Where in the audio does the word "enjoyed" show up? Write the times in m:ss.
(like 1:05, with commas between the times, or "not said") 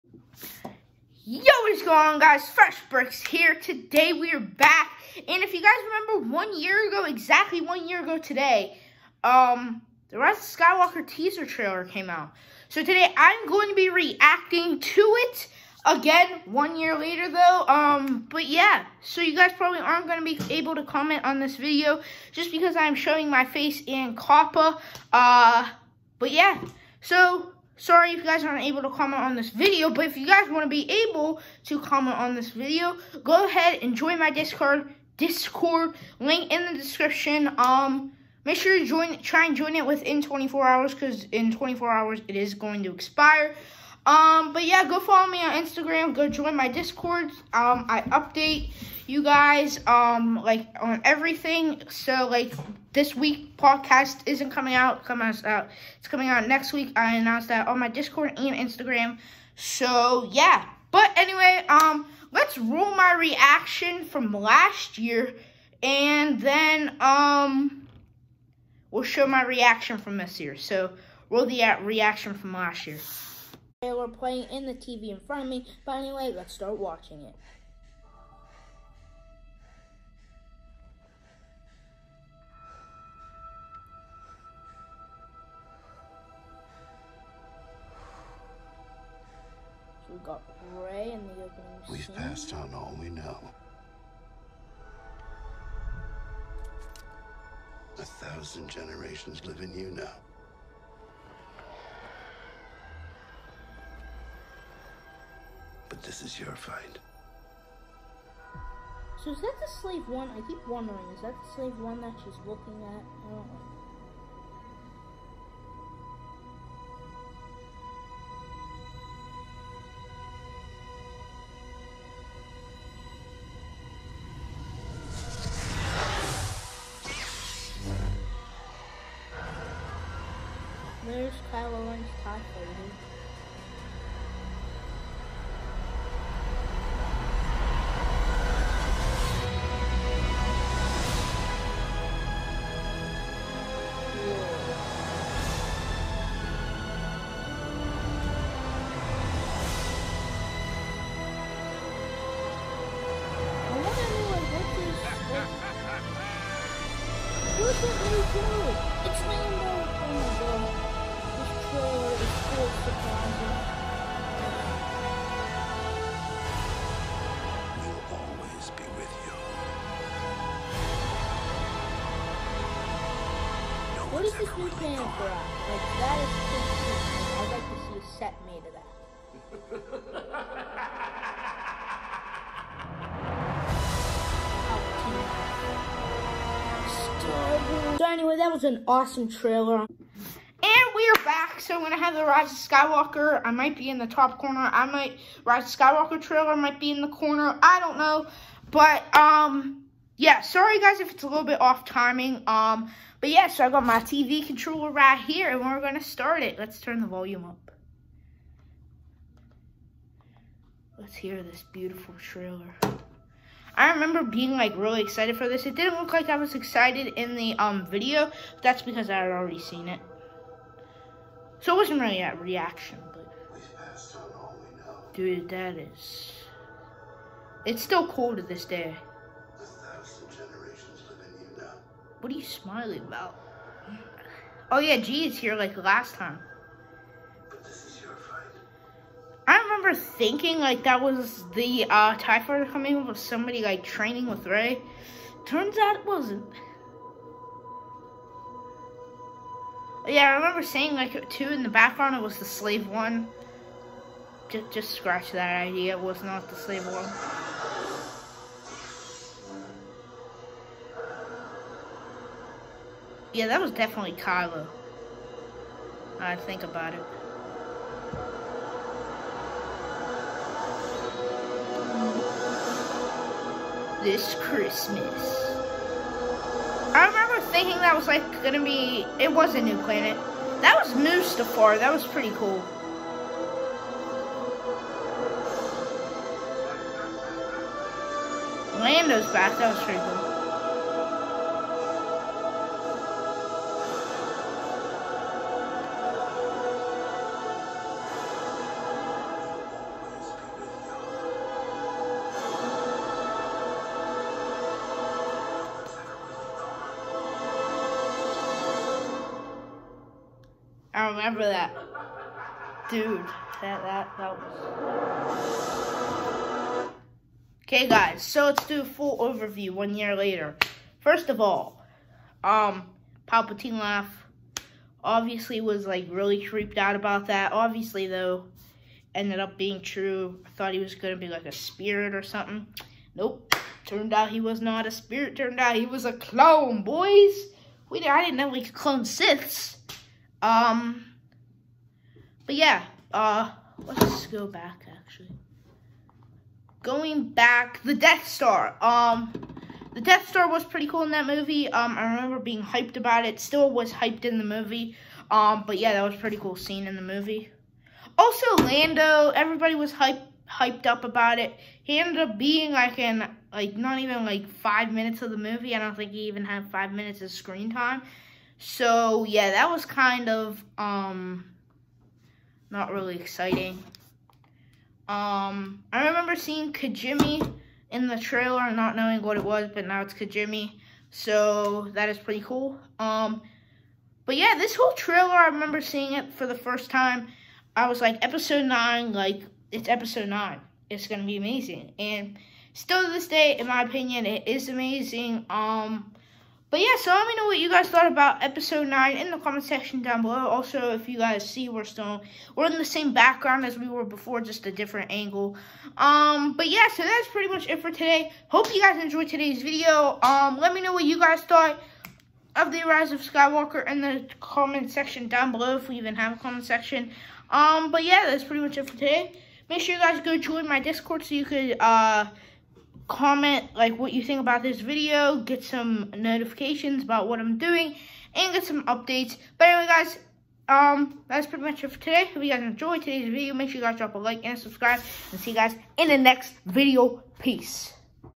6:49, 7:12.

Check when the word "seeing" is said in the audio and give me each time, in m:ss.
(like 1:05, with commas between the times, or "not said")
6:16, 6:25.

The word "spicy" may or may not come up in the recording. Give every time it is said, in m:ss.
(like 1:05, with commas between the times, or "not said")
not said.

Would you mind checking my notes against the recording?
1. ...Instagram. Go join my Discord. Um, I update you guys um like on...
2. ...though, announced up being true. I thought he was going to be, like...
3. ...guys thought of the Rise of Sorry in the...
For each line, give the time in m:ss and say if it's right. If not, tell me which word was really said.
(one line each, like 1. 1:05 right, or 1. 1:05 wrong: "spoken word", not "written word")
1. 0:45 right
2. 5:28 wrong: "ended", not "announced"
3. 6:51 wrong: "Skywalker", not "Sorry".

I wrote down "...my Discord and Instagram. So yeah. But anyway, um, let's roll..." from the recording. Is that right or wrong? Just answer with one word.
right.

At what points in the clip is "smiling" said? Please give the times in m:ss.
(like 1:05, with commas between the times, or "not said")
3:52.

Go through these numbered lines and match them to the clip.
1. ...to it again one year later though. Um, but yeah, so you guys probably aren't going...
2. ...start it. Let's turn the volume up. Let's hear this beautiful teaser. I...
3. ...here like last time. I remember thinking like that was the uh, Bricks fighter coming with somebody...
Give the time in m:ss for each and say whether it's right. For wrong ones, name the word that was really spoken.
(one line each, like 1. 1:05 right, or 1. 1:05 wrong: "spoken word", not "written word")
1. 0:14 right
2. 3:26 wrong: "trailer", not "teaser"
3. 3:55 wrong: "TIE", not "Bricks".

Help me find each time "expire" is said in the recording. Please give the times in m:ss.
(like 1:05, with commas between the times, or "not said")
0:42.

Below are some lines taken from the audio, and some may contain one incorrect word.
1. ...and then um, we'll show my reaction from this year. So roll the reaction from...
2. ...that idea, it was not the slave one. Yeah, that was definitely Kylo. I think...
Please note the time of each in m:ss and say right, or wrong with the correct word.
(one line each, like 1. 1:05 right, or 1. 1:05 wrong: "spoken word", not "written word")
1. 1:05 right
2. 4:15 right.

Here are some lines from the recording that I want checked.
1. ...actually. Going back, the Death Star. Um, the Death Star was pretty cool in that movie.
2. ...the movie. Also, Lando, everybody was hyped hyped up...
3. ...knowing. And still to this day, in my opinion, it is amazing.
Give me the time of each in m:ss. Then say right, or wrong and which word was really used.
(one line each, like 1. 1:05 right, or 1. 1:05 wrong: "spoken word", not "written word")
1. 5:44 right
2. 5:56 right
3. 6:31 wrong: "amazing", not "knowing".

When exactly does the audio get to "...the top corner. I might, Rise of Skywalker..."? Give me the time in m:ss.
3:13.